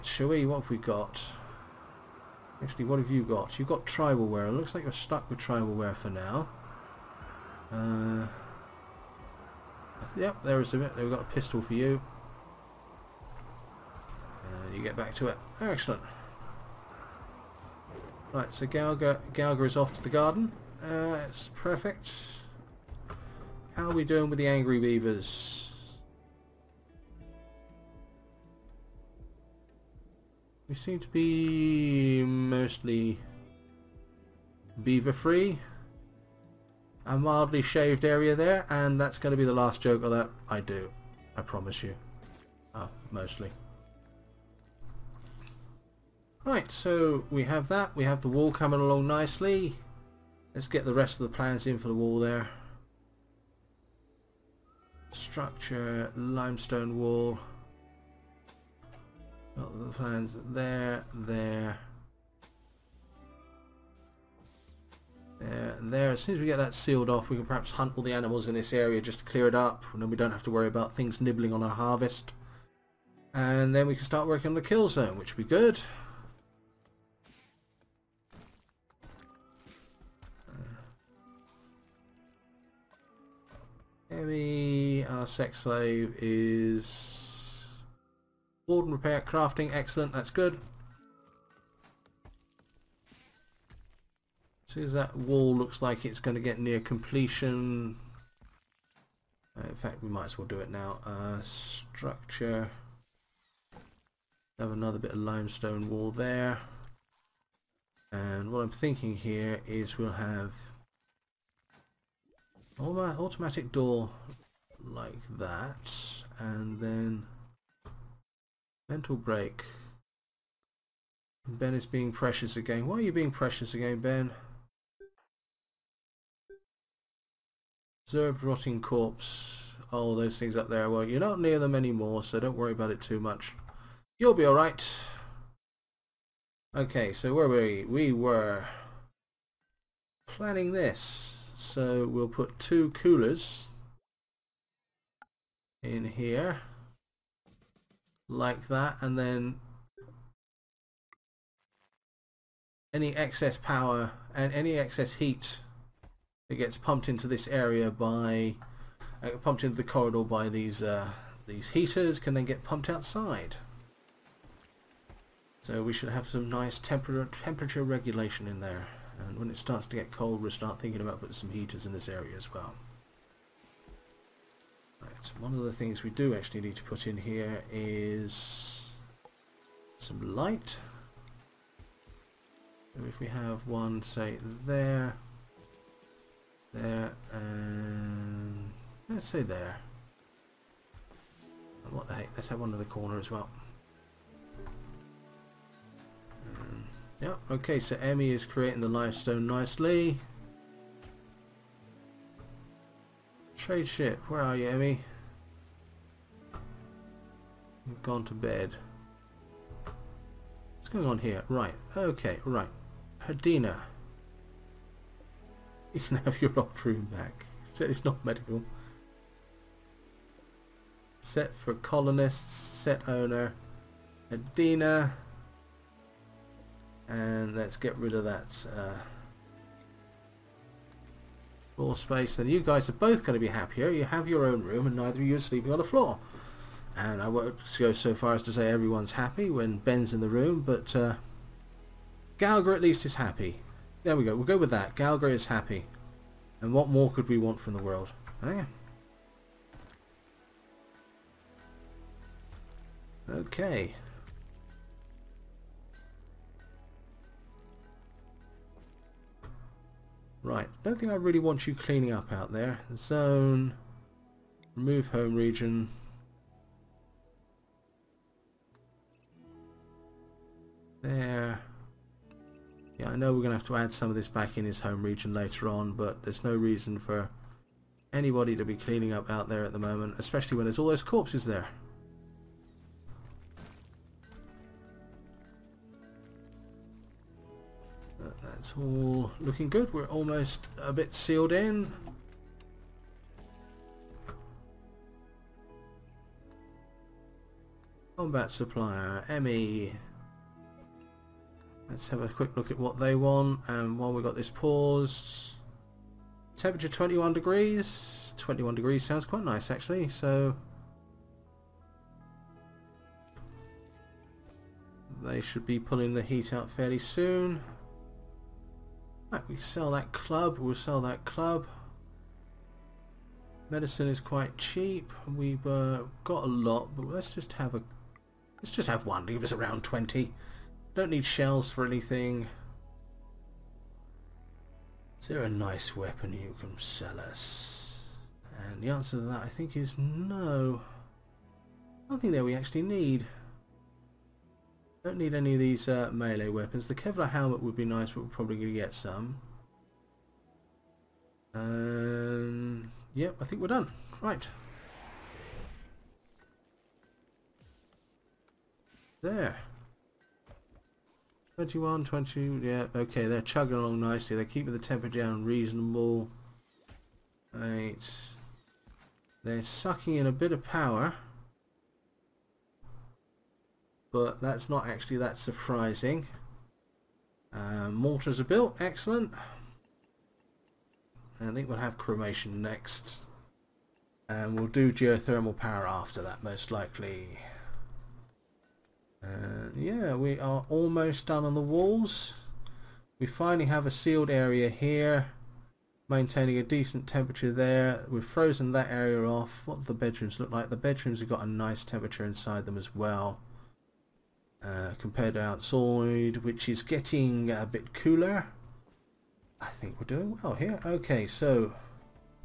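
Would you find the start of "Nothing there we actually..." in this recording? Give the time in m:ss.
5:42.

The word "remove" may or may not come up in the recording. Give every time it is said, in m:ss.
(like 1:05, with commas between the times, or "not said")
4:24.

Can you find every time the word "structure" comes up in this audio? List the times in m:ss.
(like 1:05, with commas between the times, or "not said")
0:55, 1:41.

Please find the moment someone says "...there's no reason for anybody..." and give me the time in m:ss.
4:36.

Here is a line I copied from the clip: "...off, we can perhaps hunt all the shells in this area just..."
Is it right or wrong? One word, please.
wrong.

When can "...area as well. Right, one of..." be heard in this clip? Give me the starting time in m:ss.
2:52.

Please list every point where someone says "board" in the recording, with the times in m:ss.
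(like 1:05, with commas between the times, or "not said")
1:28.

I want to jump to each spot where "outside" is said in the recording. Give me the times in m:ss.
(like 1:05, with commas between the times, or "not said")
2:42, 6:45.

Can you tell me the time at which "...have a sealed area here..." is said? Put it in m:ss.
6:33.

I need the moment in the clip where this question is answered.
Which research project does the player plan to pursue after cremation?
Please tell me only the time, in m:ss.
6:24.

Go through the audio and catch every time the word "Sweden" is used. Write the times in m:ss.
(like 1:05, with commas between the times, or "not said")
not said.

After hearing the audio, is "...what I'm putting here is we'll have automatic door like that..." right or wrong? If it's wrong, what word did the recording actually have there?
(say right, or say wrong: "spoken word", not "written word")
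wrong: "thinking", not "putting".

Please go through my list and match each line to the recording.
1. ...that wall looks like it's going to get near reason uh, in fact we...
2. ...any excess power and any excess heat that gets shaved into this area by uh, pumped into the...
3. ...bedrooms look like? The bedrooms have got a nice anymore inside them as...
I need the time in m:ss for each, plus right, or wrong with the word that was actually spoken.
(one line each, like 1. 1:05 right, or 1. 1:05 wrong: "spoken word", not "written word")
1. 1:34 wrong: "completion", not "reason"
2. 2:32 wrong: "pumped", not "shaved"
3. 6:39 wrong: "temperature", not "anymore".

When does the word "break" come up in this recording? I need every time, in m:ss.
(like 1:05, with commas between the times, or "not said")
1:59.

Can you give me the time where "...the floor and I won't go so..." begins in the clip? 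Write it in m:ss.
3:55.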